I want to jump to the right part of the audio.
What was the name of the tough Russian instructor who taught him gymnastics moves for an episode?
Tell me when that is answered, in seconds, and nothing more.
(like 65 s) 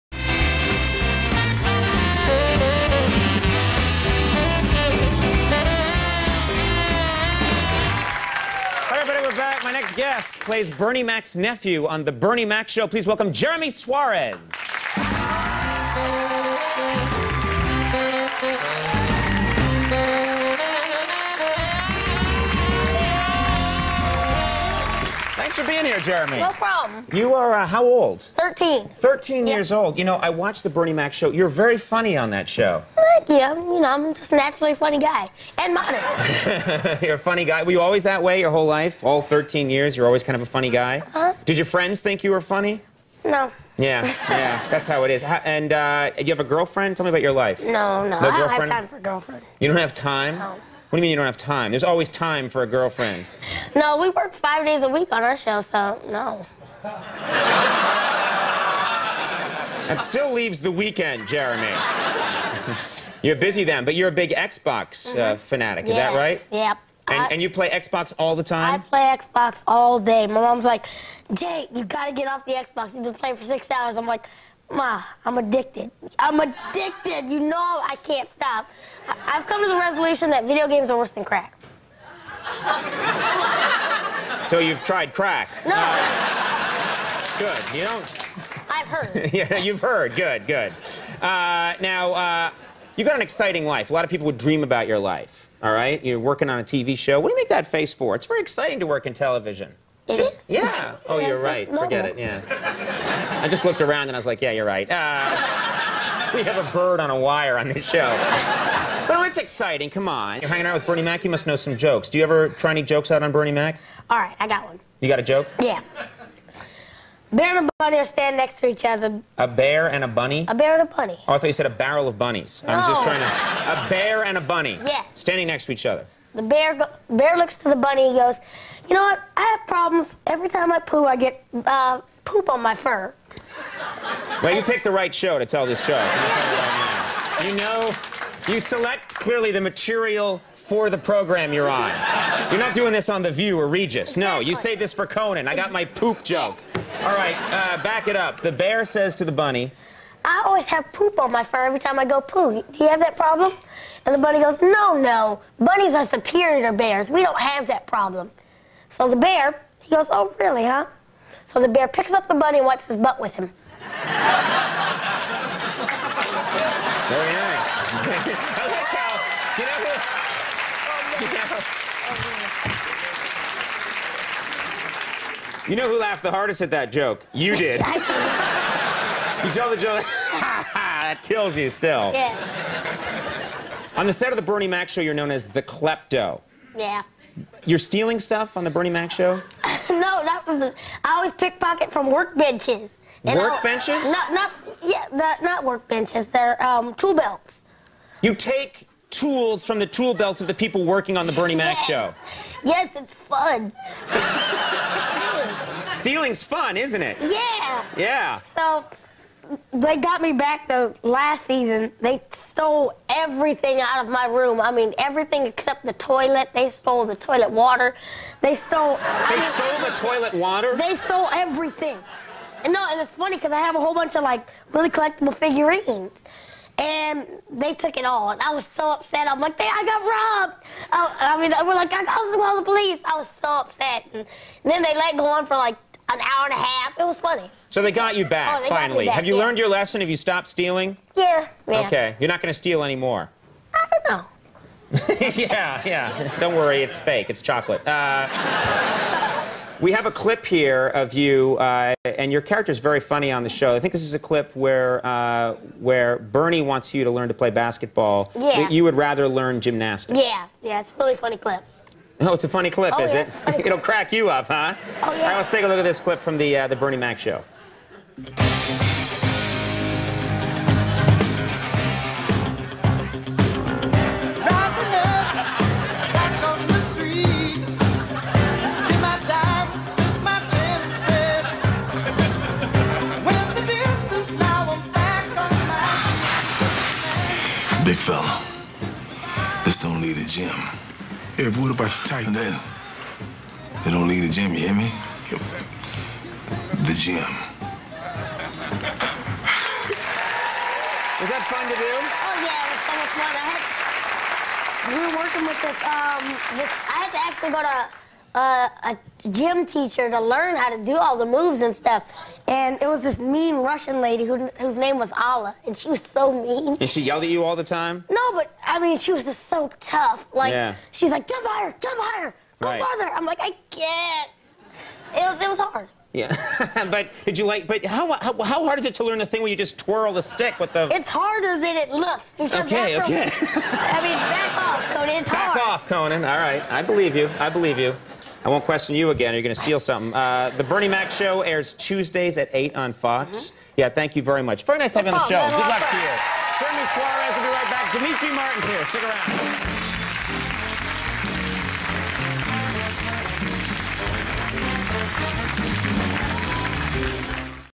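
315 s.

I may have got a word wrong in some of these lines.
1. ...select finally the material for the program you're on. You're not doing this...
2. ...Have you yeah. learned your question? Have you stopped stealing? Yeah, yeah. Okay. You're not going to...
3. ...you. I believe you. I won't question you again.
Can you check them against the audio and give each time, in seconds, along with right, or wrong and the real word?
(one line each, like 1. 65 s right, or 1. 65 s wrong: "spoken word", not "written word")
1. 138 s wrong: "clearly", not "finally"
2. 239 s wrong: "lesson", not "question"
3. 337 s right.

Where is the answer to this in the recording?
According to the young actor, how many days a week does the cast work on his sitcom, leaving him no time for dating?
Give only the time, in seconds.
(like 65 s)
54 s.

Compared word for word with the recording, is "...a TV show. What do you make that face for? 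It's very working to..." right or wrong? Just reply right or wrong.
wrong.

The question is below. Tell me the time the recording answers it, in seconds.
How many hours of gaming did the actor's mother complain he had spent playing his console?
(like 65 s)
73 s.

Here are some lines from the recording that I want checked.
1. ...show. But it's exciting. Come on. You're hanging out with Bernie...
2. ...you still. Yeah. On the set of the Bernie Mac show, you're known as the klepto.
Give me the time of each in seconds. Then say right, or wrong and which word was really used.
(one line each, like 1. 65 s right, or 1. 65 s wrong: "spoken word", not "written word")
1. 107 s right
2. 181 s right.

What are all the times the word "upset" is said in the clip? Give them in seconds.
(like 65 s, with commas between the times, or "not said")
228 s, 233 s.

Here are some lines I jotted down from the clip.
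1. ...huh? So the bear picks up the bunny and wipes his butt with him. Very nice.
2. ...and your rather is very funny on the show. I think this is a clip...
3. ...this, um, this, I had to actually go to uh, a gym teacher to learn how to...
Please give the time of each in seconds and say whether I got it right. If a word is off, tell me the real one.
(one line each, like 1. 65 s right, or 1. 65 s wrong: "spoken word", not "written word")
1. 160 s right
2. 252 s wrong: "character", not "rather"
3. 305 s right.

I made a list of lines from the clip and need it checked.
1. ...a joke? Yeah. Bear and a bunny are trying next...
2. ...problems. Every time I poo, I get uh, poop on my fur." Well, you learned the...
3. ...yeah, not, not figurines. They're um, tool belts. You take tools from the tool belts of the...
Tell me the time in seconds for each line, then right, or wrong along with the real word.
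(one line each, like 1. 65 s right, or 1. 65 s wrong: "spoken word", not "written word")
1. 115 s wrong: "standing", not "trying"
2. 129 s wrong: "picked", not "learned"
3. 194 s wrong: "workbenches", not "figurines".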